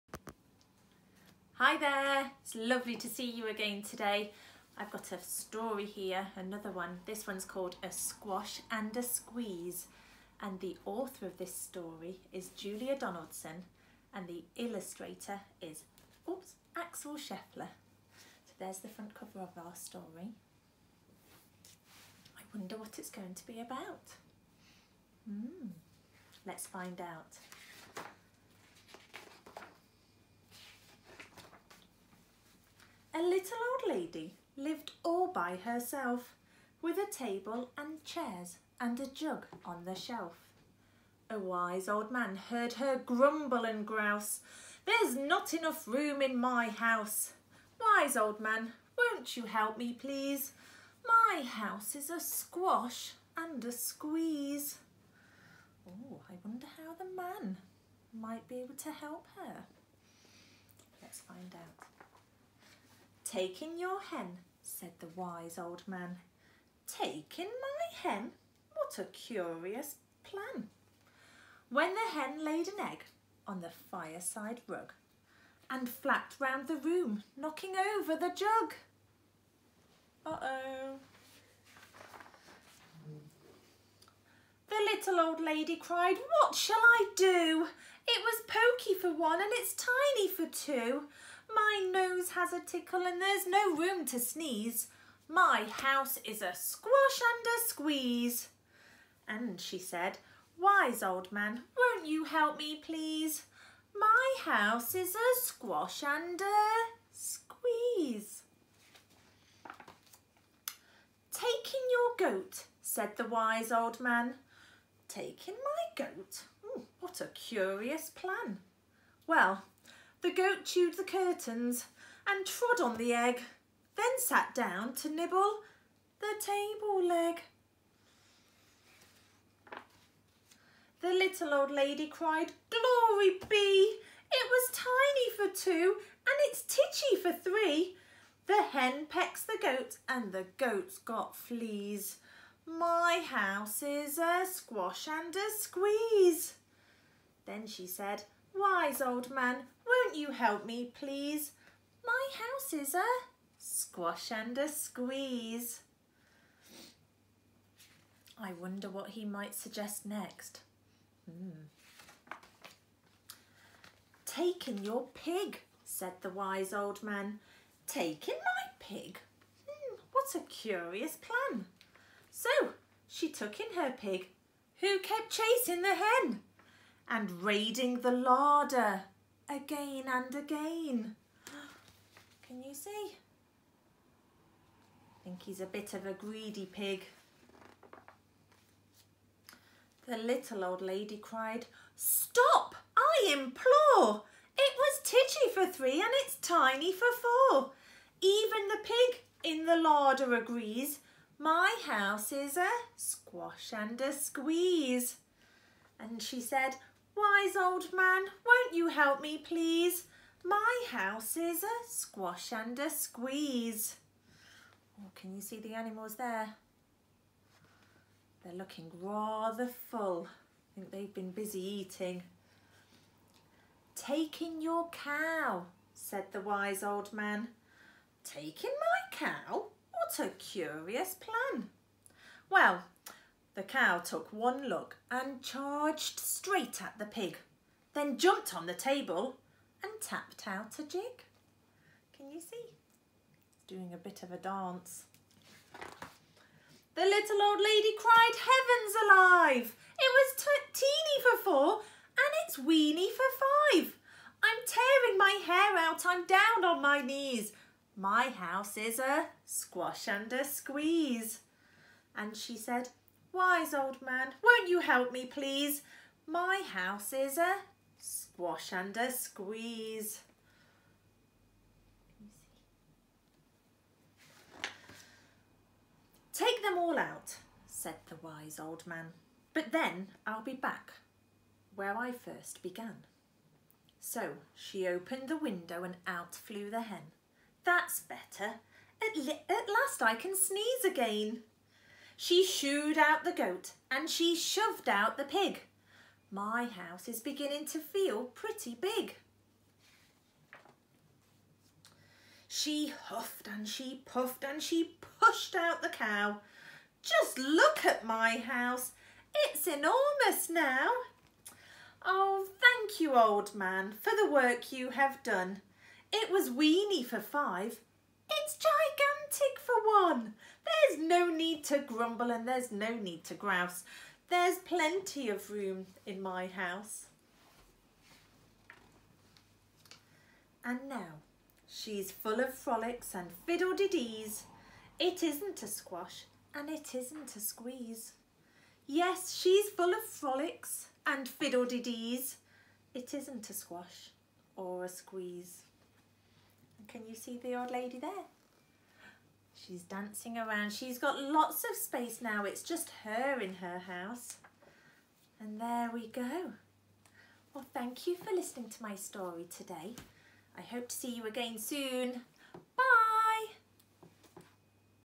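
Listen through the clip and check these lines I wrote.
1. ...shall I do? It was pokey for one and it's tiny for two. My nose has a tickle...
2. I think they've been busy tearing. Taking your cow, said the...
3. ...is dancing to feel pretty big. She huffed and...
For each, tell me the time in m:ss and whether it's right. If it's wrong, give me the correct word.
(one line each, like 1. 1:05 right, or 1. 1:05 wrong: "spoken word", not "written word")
1. 1:26 right
2. 3:40 wrong: "eating", not "tearing"
3. 4:57 wrong: "beginning", not "dancing".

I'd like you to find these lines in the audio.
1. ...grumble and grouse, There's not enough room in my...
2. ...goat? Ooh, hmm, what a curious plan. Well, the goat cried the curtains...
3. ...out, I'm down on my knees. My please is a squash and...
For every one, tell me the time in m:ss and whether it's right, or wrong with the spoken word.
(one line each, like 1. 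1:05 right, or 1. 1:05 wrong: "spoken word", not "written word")
1. 0:42 right
2. 1:56 wrong: "chewed", not "cried"
3. 4:15 wrong: "house", not "please".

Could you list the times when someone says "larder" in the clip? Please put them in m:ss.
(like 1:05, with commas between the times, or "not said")
2:58, 3:19.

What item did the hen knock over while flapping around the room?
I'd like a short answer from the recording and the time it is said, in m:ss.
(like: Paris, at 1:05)
the jug, at 1:17.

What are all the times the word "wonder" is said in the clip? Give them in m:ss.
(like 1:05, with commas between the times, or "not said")
0:22, 0:56, 2:38.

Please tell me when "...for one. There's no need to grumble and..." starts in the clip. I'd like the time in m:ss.
5:19.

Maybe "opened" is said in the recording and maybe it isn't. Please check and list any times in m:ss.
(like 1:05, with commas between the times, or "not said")
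4:44.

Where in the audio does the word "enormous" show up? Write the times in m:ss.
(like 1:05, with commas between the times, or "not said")
5:09.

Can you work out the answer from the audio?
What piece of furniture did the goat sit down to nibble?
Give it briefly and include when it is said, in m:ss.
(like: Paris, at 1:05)
the table leg, at 2:05.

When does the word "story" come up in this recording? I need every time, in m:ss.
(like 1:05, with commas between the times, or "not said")
0:05, 0:11, 0:19, 5:58.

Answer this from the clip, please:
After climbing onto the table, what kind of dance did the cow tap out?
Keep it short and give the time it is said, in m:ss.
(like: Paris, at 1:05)
a jig, at 4:00.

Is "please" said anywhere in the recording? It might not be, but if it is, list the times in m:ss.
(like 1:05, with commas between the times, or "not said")
0:49, 1:42, 2:30, 3:29, 4:25.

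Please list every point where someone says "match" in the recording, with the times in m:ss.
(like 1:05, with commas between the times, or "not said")
not said.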